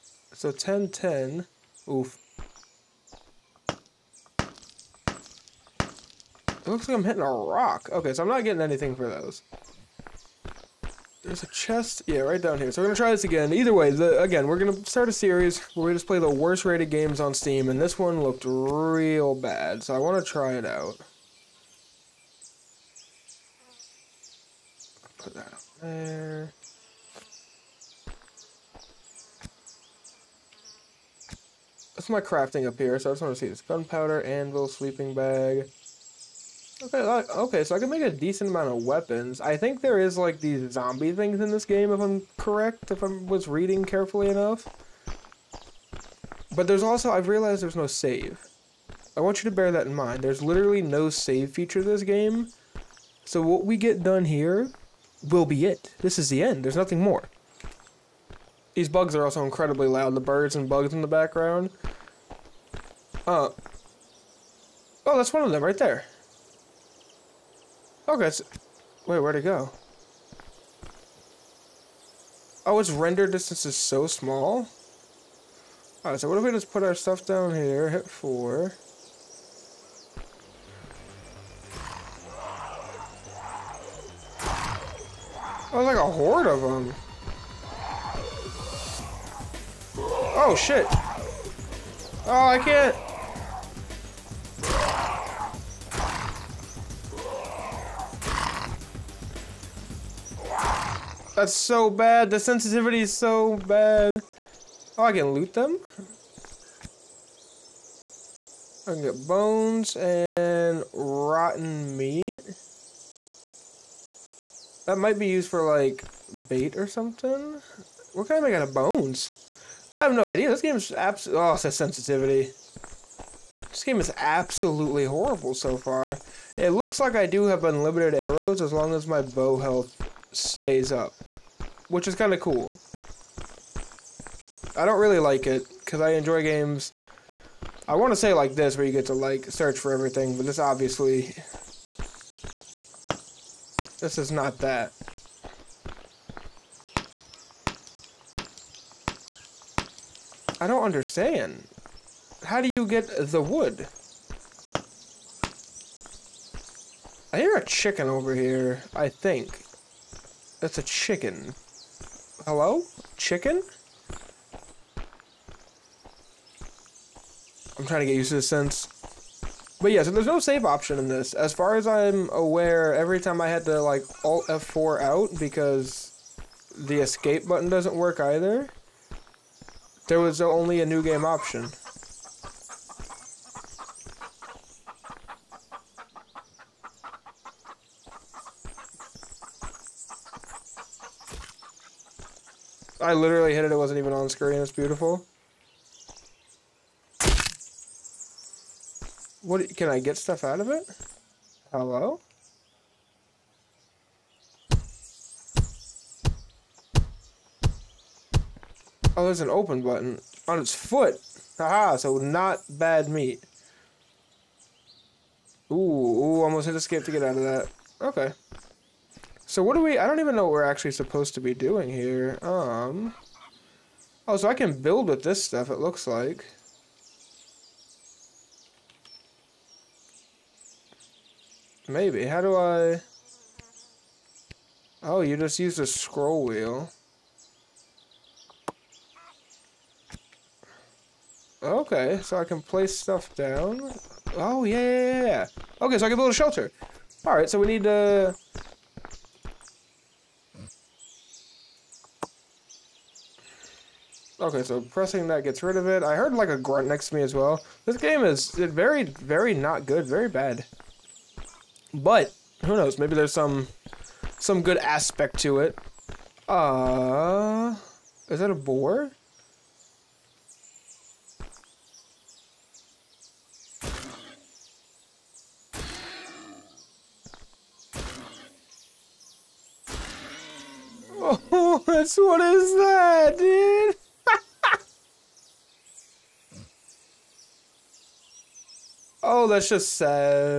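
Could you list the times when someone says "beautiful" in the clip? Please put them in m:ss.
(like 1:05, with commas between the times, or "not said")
3:14.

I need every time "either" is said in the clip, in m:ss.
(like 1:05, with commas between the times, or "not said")
0:13, 2:58.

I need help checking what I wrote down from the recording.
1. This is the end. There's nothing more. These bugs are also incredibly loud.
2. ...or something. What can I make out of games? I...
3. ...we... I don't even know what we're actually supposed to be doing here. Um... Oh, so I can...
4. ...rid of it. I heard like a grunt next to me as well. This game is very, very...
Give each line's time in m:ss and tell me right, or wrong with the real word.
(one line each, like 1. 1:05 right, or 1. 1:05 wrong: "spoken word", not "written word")
1. 0:55 right
2. 1:56 wrong: "bones", not "games"
3. 3:39 right
4. 4:15 right.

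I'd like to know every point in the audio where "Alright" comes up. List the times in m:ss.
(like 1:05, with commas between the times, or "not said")
1:16, 4:07.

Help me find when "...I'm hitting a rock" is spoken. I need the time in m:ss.
0:06.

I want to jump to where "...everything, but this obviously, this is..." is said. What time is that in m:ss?
2:19.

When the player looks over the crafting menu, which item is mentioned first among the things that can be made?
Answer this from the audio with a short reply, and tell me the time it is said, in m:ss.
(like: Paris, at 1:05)
Gunpowder, at 0:33.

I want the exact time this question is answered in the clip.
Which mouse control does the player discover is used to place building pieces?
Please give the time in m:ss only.
3:55.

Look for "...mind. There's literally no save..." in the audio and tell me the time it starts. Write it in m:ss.
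0:49.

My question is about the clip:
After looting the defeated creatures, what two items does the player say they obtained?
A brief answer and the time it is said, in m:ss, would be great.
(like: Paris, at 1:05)
Bones and rotten meat, at 1:49.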